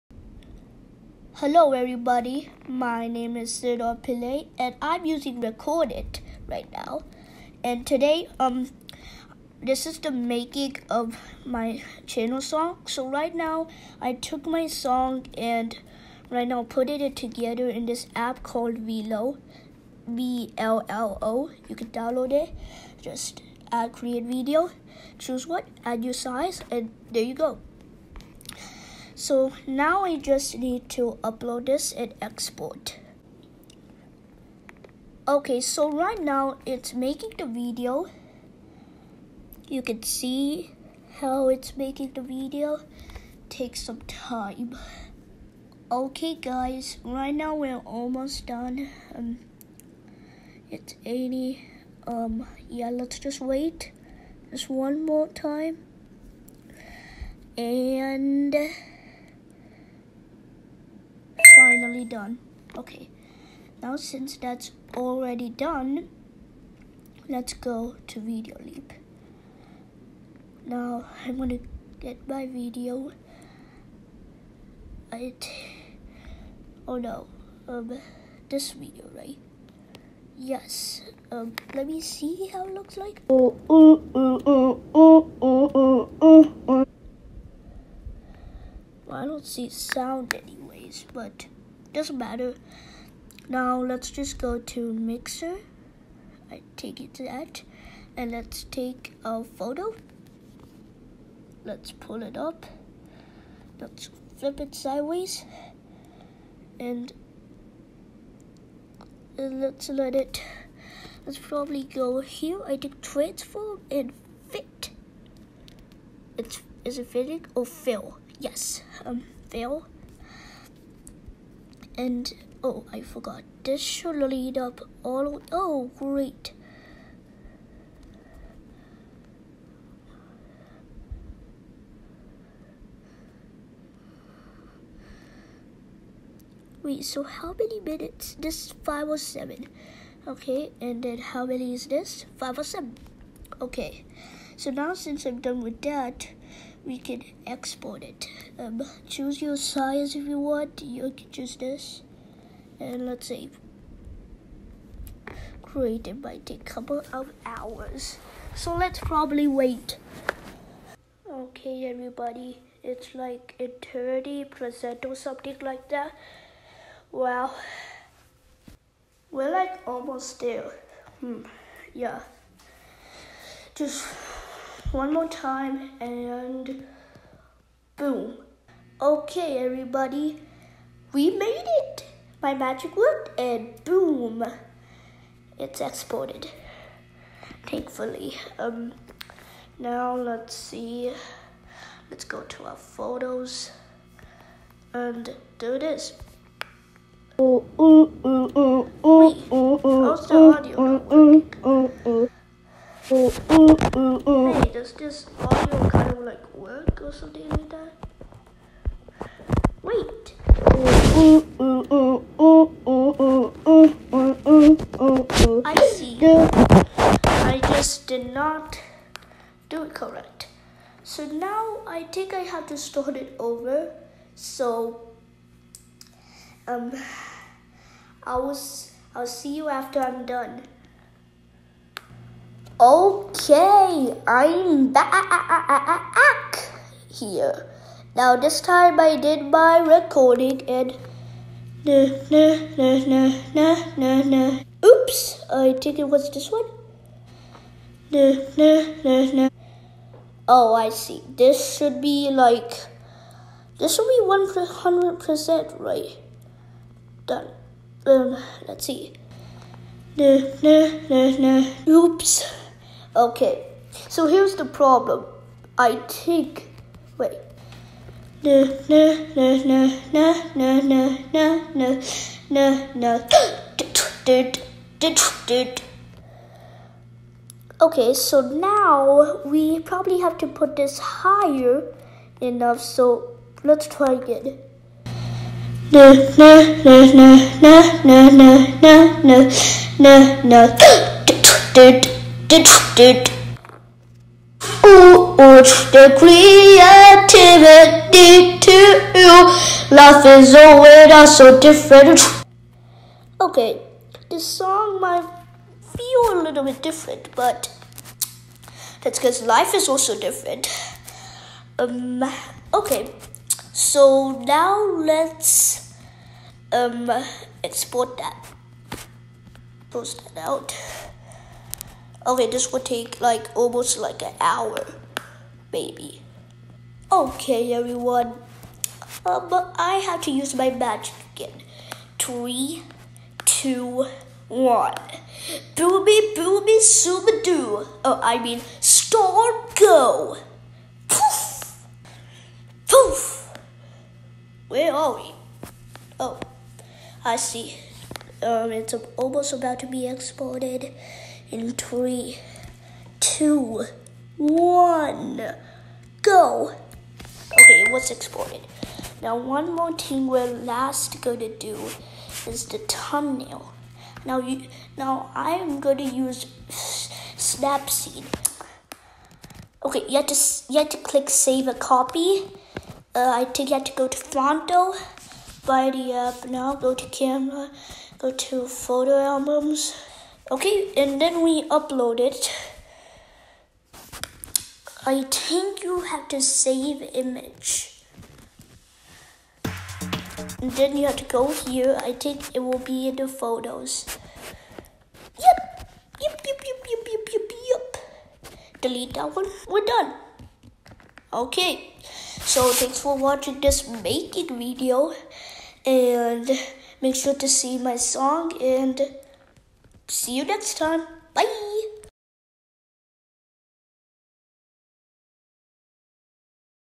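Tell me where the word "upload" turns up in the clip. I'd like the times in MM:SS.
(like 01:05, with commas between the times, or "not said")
00:31, 06:21.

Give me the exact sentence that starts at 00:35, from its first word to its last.
Okay, so right now it's making the video.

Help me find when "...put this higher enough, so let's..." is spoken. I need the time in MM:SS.
04:40.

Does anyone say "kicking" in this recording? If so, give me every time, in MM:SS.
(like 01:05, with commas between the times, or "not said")
not said.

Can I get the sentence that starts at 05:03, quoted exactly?
Okay, this song might feel a little bit different, but that's because life is also different.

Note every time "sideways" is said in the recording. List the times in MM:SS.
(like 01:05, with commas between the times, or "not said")
01:44.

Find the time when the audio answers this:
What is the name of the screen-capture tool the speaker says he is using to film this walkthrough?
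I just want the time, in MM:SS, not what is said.
00:05.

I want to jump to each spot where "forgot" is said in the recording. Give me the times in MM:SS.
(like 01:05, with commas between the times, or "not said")
02:03.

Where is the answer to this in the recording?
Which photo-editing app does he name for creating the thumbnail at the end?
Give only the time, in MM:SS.
06:06.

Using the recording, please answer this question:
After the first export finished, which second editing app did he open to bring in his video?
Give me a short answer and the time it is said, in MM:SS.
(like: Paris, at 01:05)
Videoleap, at 01:08.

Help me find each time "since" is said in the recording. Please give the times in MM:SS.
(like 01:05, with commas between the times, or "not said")
01:03, 02:24.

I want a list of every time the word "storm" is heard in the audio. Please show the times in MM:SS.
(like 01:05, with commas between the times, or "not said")
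05:38.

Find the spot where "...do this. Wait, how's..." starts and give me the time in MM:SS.
03:15.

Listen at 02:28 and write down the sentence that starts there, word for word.
Um, choose your size if you want.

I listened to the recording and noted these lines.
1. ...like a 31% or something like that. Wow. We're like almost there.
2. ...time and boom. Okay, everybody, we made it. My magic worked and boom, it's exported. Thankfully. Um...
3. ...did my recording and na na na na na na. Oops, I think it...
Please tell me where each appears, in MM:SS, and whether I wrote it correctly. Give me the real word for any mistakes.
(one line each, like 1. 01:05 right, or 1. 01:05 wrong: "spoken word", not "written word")
1. 02:43 wrong: "30", not "31"
2. 02:55 right
3. 03:59 right.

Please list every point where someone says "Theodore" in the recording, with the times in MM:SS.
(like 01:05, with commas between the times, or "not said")
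00:03.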